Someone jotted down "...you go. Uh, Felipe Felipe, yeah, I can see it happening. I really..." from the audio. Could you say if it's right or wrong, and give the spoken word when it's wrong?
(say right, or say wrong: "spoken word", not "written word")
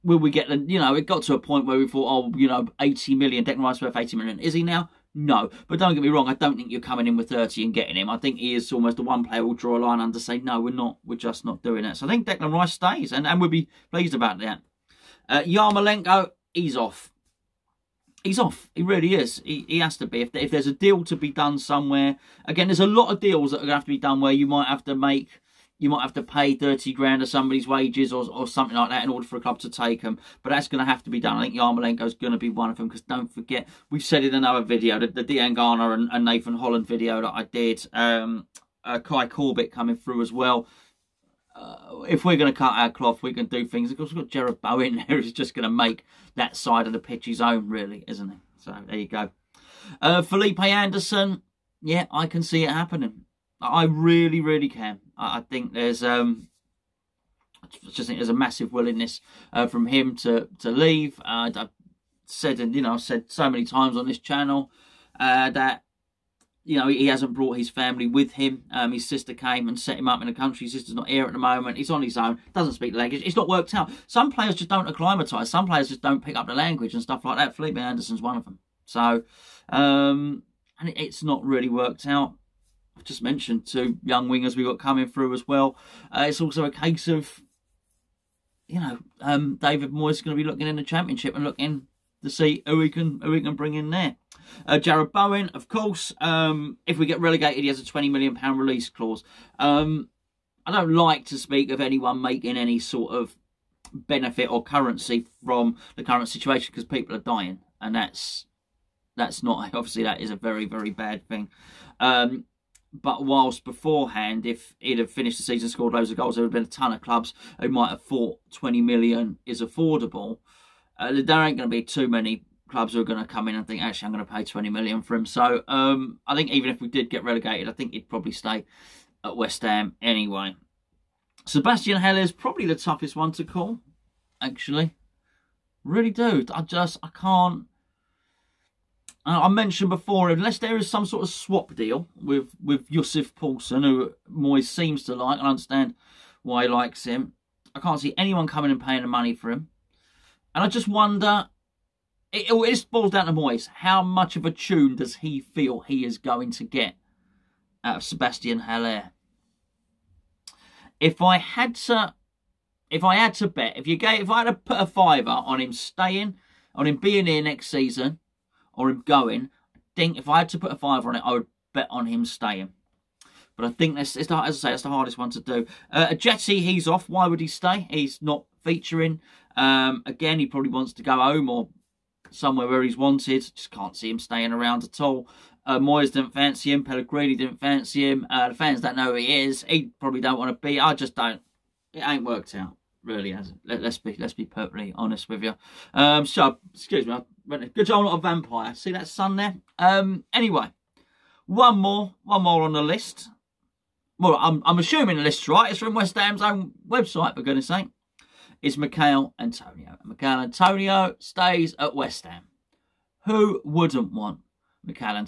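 wrong: "Anderson", not "Felipe".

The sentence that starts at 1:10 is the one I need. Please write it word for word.
His sister's not here at the moment.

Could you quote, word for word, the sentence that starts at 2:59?
Um, again, he probably wants to go home or somewhere where he's wanted.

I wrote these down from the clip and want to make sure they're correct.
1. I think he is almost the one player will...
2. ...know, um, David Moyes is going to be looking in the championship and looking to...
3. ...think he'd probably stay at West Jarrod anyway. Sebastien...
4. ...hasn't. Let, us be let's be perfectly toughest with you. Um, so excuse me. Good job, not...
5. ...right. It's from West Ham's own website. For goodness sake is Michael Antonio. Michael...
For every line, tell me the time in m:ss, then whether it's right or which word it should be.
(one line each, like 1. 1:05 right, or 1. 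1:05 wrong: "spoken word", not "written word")
1. 0:08 right
2. 1:28 right
3. 2:07 wrong: "Ham", not "Jarrod"
4. 3:13 wrong: "honest", not "toughest"
5. 3:25 right.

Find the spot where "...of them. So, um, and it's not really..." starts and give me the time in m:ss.
1:18.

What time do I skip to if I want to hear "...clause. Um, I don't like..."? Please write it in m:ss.
1:38.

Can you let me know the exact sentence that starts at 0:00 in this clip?
You know, it got to a point where we thought, oh, you know, eighty million.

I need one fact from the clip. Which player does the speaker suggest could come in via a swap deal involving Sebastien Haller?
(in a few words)
Yussuf Poulsen.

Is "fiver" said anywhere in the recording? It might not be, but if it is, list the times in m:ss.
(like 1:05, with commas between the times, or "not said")
2:44, 2:50.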